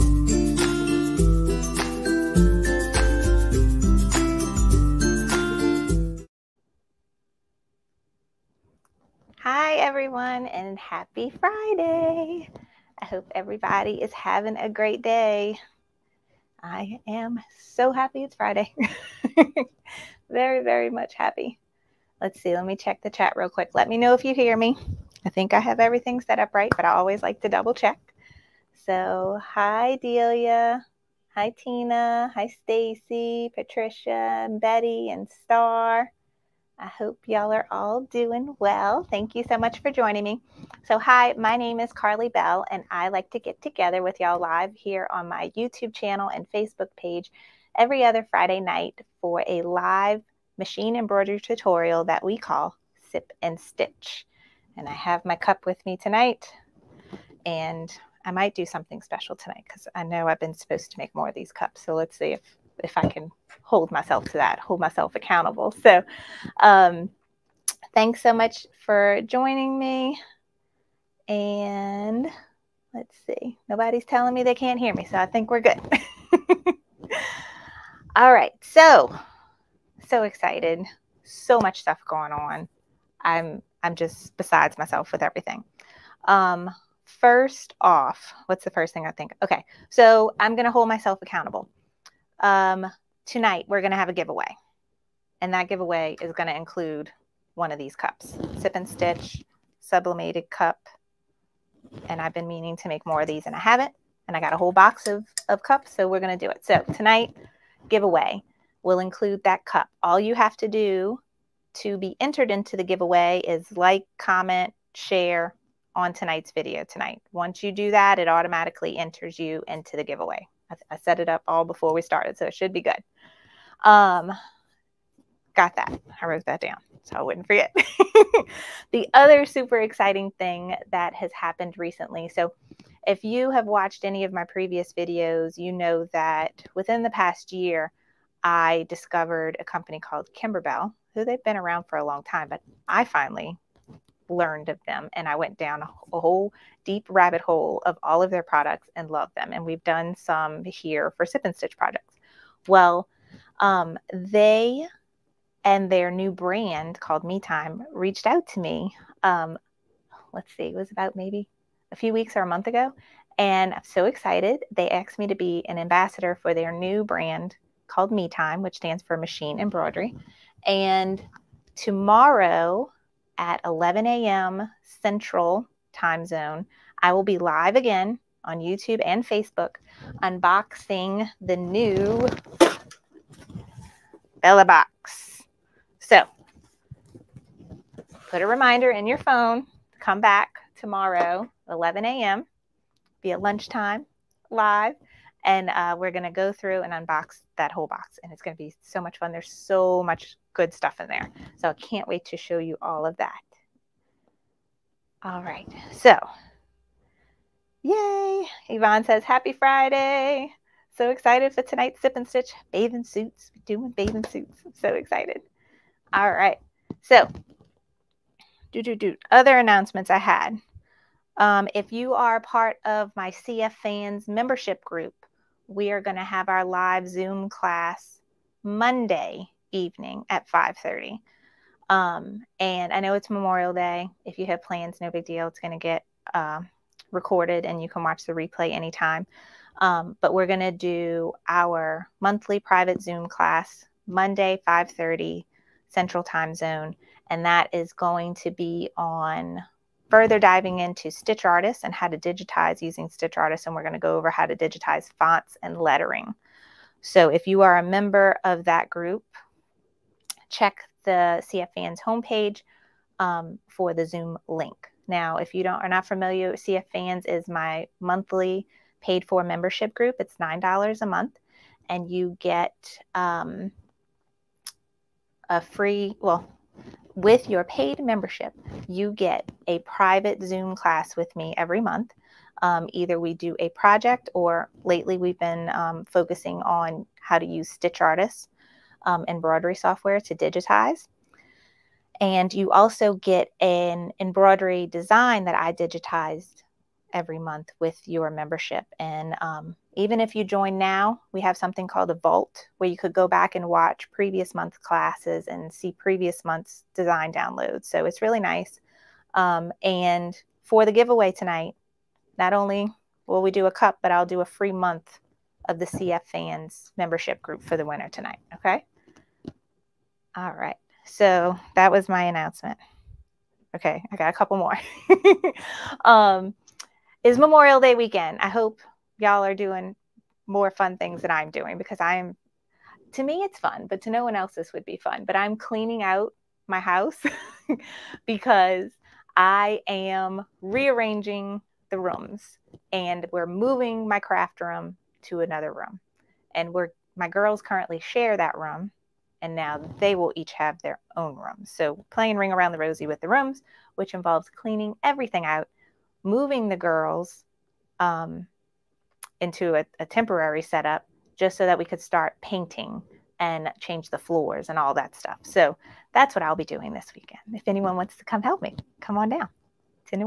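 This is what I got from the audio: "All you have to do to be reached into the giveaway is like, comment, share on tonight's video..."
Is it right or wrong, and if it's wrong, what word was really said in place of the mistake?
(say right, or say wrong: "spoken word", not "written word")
wrong: "entered", not "reached".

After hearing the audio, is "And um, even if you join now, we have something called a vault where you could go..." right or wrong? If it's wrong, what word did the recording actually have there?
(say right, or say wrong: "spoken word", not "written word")
right.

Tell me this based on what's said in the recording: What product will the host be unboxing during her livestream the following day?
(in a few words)
Bella Box.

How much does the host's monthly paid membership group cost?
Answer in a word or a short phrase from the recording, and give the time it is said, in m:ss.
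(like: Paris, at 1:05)
$9 a month, at 4:30.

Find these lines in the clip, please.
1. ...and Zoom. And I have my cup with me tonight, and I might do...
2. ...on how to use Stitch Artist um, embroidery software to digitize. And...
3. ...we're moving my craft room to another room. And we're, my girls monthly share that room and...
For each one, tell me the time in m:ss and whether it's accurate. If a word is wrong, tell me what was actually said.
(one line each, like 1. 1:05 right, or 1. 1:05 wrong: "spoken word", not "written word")
1. 0:53 wrong: "Stitch", not "Zoom"
2. 4:46 right
3. 5:43 wrong: "currently", not "monthly".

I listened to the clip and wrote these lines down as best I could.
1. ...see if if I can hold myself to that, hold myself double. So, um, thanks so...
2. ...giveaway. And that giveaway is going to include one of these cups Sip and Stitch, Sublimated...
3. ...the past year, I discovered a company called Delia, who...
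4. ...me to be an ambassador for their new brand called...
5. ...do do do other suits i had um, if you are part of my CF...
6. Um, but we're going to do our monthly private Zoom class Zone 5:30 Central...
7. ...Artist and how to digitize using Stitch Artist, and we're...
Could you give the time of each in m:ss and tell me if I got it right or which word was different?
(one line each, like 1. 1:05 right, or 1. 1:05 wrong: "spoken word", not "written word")
1. 1:02 wrong: "accountable", not "double"
2. 1:34 right
3. 2:17 wrong: "Kimberbell", not "Delia"
4. 2:45 right
5. 3:38 wrong: "announcements", not "suits"
6. 3:59 wrong: "Monday", not "Zone"
7. 4:11 right.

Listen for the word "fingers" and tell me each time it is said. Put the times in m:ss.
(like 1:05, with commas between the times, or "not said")
not said.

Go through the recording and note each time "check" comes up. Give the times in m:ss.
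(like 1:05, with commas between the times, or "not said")
0:22, 0:27, 4:20.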